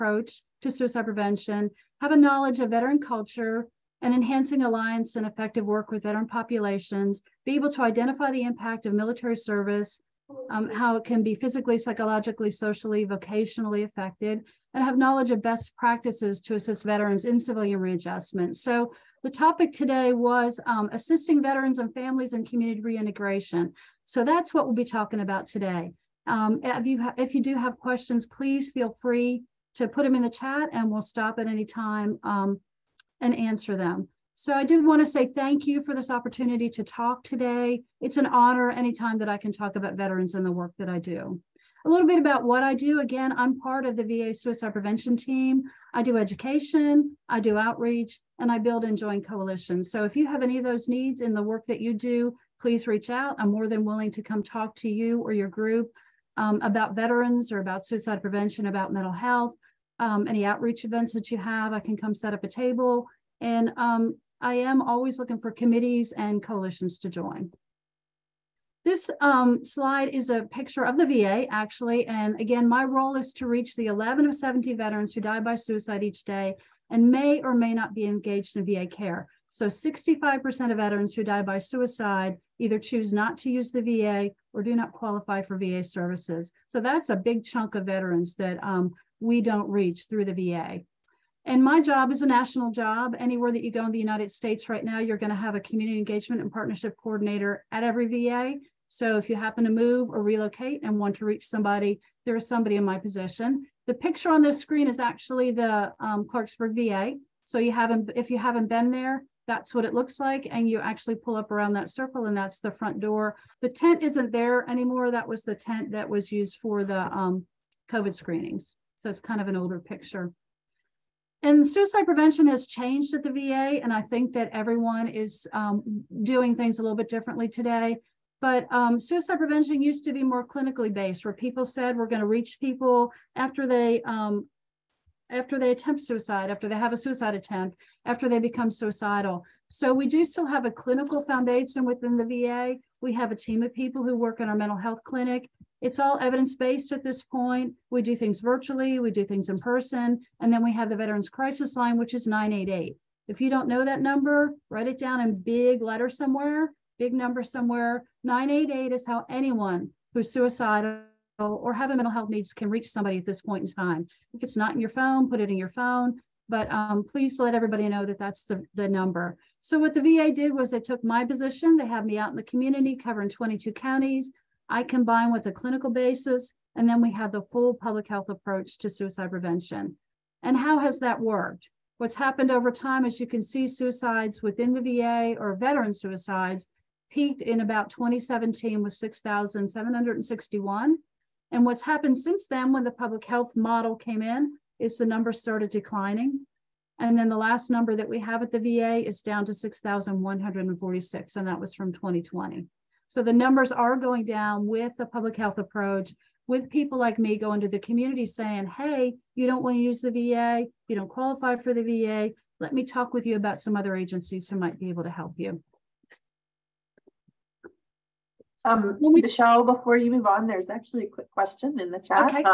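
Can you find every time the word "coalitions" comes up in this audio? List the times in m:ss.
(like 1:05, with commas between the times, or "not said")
0:49, 1:06.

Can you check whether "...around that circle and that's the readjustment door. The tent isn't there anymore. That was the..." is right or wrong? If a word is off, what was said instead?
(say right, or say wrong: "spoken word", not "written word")
wrong: "front", not "readjustment".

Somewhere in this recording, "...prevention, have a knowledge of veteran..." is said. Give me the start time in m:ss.
0:01.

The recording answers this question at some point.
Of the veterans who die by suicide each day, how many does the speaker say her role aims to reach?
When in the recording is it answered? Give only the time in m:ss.
1:13.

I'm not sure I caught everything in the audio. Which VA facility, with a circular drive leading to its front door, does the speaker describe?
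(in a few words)
Clarksburg.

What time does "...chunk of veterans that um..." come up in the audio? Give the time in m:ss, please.
1:27.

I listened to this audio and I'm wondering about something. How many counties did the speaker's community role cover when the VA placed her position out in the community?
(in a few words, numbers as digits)
22.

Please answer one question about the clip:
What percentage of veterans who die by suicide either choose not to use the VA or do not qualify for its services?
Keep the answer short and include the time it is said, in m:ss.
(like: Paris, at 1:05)
65%, at 1:19.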